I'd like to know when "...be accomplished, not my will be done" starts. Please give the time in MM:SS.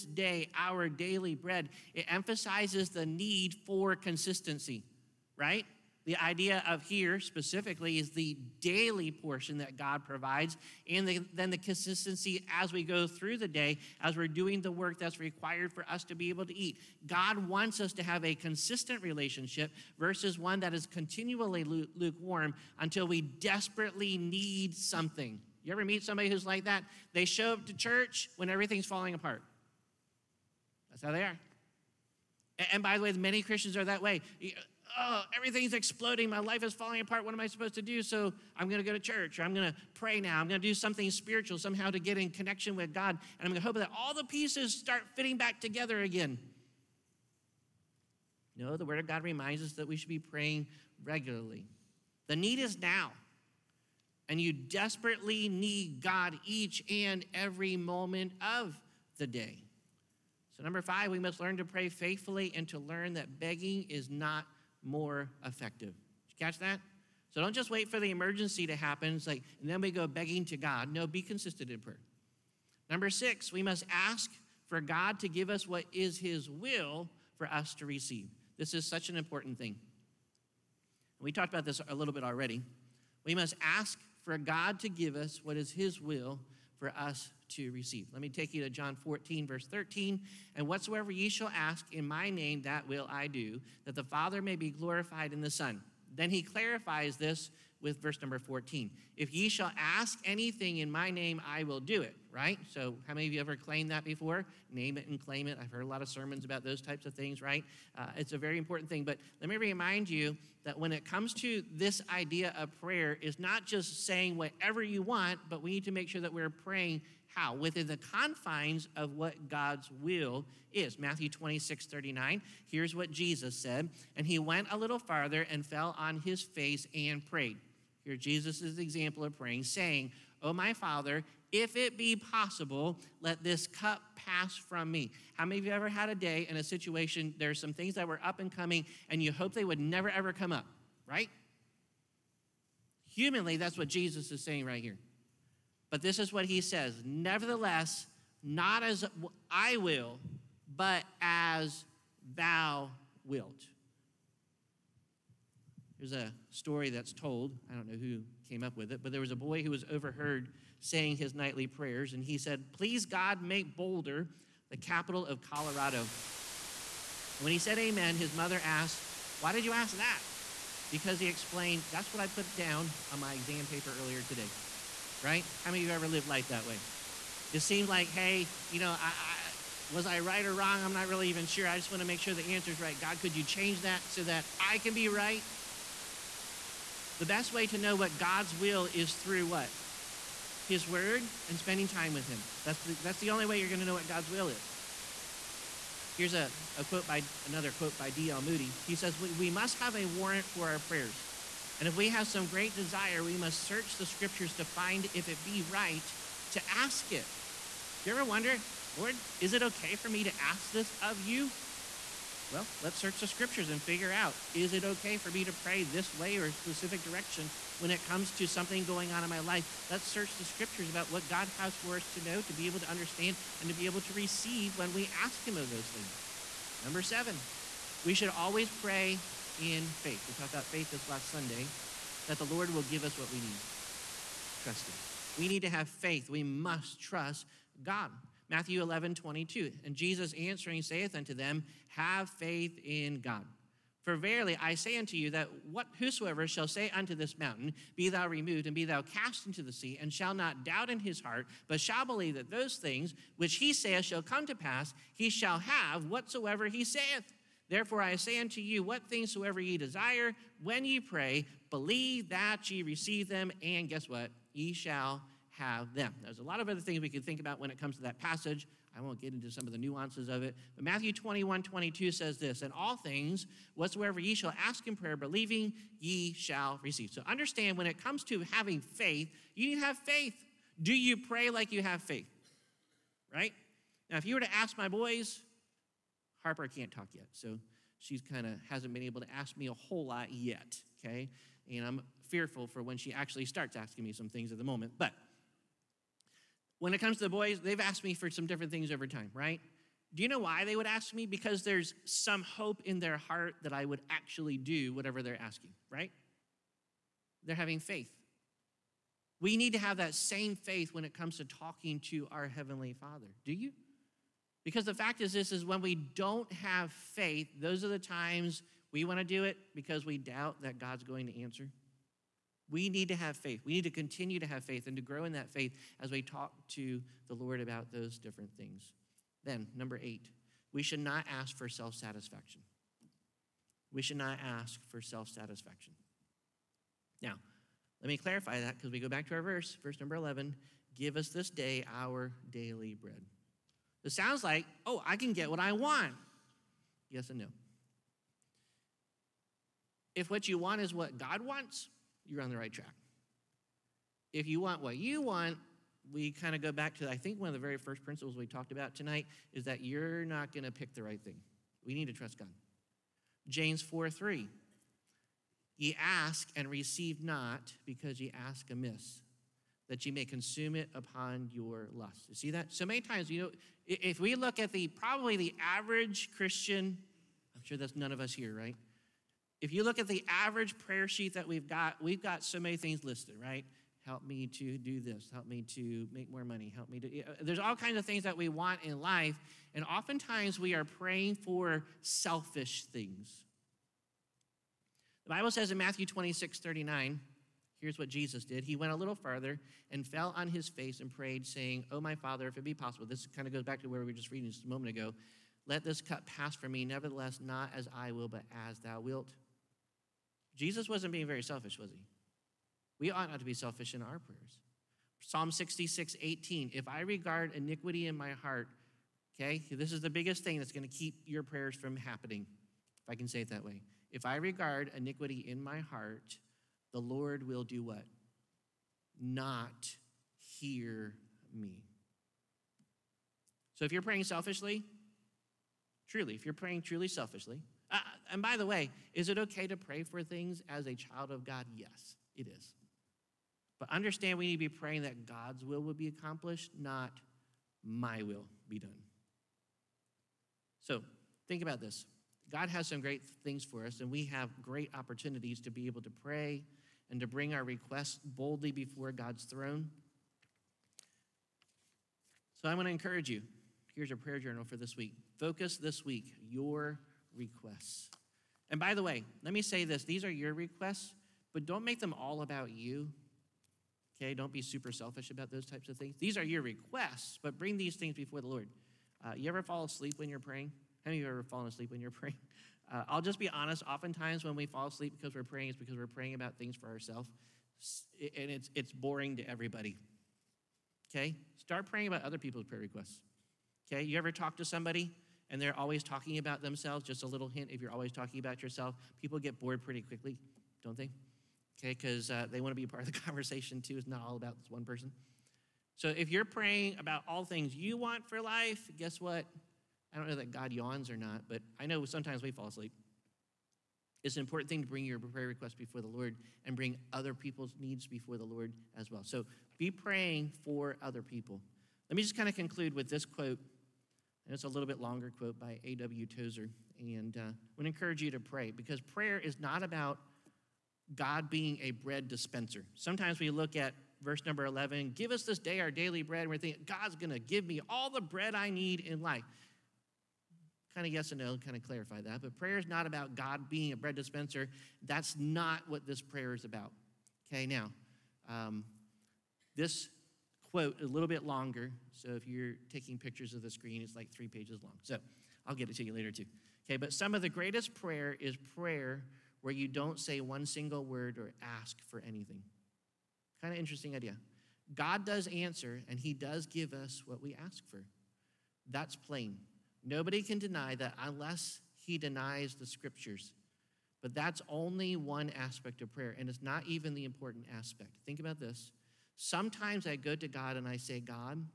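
07:25.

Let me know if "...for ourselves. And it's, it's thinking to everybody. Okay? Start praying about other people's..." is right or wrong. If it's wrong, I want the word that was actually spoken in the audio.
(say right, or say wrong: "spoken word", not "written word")
wrong: "boring", not "thinking".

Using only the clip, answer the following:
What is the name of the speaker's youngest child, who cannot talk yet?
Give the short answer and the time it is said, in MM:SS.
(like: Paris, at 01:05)
Harper, at 04:46.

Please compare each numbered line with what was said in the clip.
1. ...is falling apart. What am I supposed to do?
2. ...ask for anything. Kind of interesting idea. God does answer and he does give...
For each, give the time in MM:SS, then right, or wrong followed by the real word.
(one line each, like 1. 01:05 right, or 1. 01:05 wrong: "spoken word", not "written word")
1. 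00:36 right
2. 09:21 right.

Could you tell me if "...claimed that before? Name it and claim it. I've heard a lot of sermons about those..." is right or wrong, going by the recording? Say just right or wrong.
right.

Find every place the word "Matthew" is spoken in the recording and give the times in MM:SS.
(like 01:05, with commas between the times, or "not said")
02:00, 03:58, 04:30, 06:35.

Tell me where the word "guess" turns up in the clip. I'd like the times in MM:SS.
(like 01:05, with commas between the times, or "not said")
04:23, 08:28.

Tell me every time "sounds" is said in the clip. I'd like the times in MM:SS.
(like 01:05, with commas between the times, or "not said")
05:44.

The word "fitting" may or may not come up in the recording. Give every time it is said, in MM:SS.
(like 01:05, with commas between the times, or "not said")
00:45.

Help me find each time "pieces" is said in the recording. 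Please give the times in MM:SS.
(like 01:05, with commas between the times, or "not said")
00:44.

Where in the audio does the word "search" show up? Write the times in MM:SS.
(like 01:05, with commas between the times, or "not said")
03:23, 03:32, 03:40.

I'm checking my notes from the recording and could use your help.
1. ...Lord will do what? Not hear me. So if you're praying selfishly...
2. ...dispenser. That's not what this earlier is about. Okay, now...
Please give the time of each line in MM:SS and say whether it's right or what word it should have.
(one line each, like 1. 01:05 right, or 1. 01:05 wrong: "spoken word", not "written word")
1. 07:06 right
2. 09:04 wrong: "prayer", not "earlier".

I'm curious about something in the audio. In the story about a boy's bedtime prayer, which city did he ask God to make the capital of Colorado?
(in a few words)
Boulder.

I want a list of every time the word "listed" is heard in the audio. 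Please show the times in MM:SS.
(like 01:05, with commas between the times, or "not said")
06:23.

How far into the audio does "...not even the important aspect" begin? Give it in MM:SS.
09:36.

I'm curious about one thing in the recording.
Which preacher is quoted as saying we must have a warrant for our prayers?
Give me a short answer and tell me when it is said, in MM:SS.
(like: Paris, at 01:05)
D.L. Moody, at 03:18.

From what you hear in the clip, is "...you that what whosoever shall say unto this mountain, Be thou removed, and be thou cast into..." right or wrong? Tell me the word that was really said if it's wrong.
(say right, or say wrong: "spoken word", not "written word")
right.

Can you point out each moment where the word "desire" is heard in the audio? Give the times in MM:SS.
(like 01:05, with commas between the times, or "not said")
03:22, 04:19.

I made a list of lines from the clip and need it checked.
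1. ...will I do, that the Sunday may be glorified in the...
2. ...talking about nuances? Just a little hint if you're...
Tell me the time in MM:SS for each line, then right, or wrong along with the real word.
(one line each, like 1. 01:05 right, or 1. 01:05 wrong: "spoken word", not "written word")
1. 01:32 wrong: "Father", not "Sunday"
2. 08:16 wrong: "themselves", not "nuances".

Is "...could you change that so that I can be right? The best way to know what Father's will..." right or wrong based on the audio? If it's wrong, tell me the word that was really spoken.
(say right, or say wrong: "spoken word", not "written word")
wrong: "God", not "Father".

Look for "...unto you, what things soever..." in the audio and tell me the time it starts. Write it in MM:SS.
04:18.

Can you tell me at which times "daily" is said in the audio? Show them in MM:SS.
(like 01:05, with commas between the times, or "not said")
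00:00, 00:08, 05:42, 08:55.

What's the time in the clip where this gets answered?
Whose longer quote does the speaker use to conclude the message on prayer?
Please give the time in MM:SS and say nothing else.
08:45.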